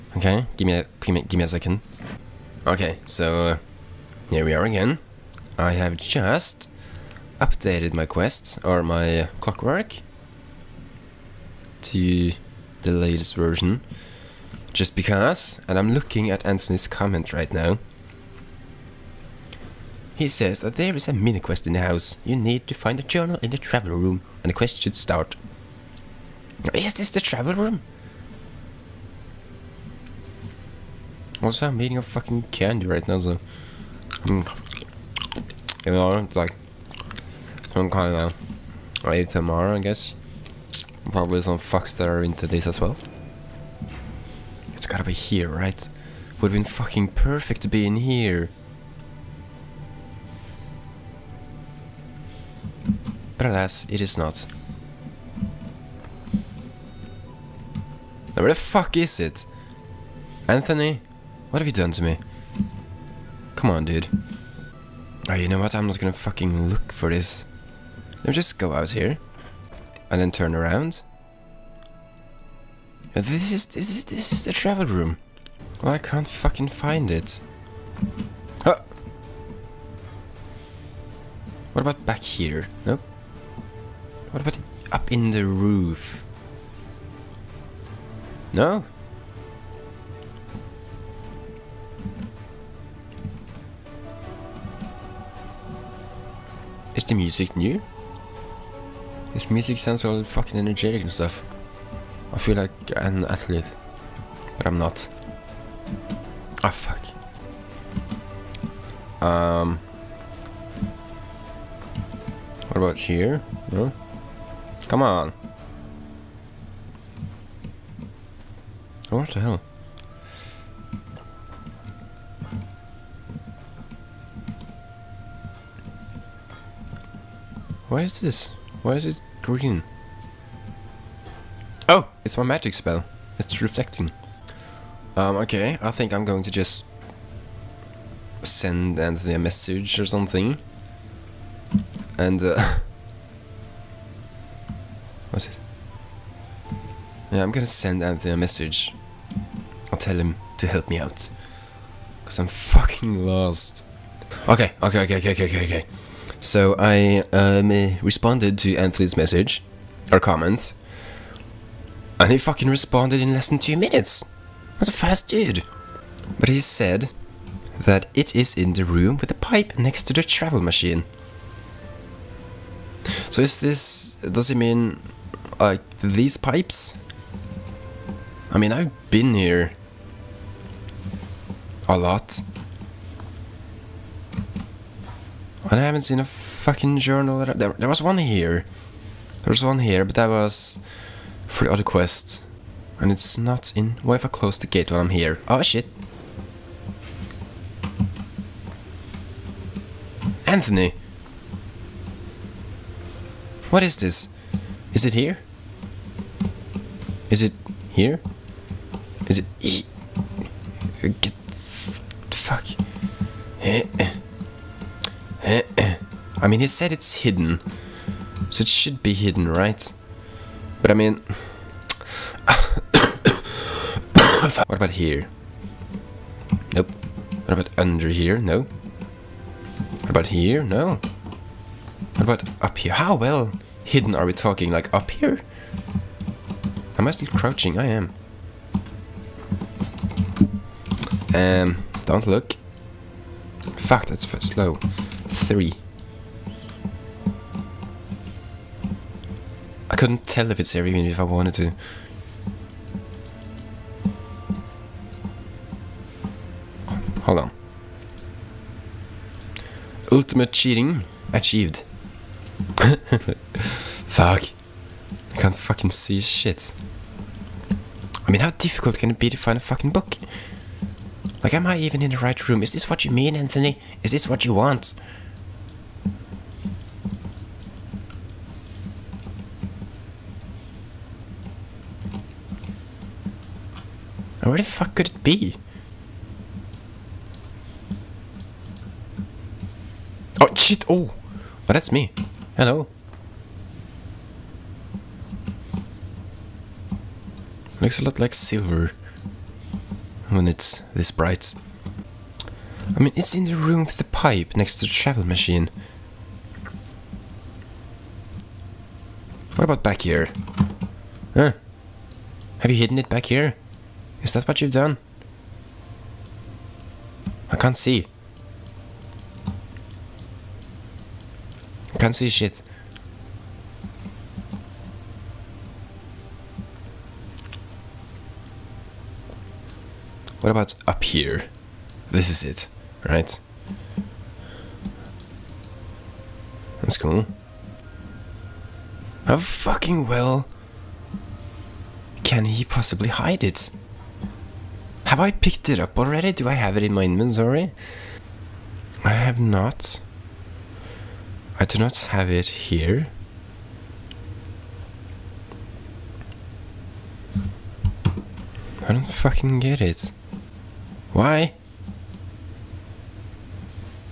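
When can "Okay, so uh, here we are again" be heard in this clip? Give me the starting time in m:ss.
0:02.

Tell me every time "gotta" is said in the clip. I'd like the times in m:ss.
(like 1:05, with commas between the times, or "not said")
0:44.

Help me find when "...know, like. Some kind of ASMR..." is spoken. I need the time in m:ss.
0:35.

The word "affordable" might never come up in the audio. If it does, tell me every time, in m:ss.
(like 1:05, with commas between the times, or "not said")
not said.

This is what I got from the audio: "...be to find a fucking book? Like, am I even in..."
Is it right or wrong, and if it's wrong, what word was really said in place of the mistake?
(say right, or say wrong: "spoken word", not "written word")
right.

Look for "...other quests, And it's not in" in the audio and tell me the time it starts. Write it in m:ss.
3:11.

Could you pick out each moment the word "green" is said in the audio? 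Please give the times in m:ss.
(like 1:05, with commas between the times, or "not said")
2:09.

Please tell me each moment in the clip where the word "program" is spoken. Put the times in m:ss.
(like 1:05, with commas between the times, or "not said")
not said.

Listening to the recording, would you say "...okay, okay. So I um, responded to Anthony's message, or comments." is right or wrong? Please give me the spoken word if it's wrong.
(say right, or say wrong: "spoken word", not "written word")
right.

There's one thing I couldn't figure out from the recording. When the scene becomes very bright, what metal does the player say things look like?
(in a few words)
Silver.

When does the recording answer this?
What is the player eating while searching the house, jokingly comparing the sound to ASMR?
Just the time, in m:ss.
0:32.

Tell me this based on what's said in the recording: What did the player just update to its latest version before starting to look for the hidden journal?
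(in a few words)
Clockwork.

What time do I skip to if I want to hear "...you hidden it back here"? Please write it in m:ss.
5:12.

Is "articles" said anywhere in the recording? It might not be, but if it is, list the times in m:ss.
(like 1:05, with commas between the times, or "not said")
not said.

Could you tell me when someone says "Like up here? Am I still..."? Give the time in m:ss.
3:54.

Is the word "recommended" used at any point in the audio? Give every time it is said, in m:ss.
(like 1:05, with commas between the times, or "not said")
not said.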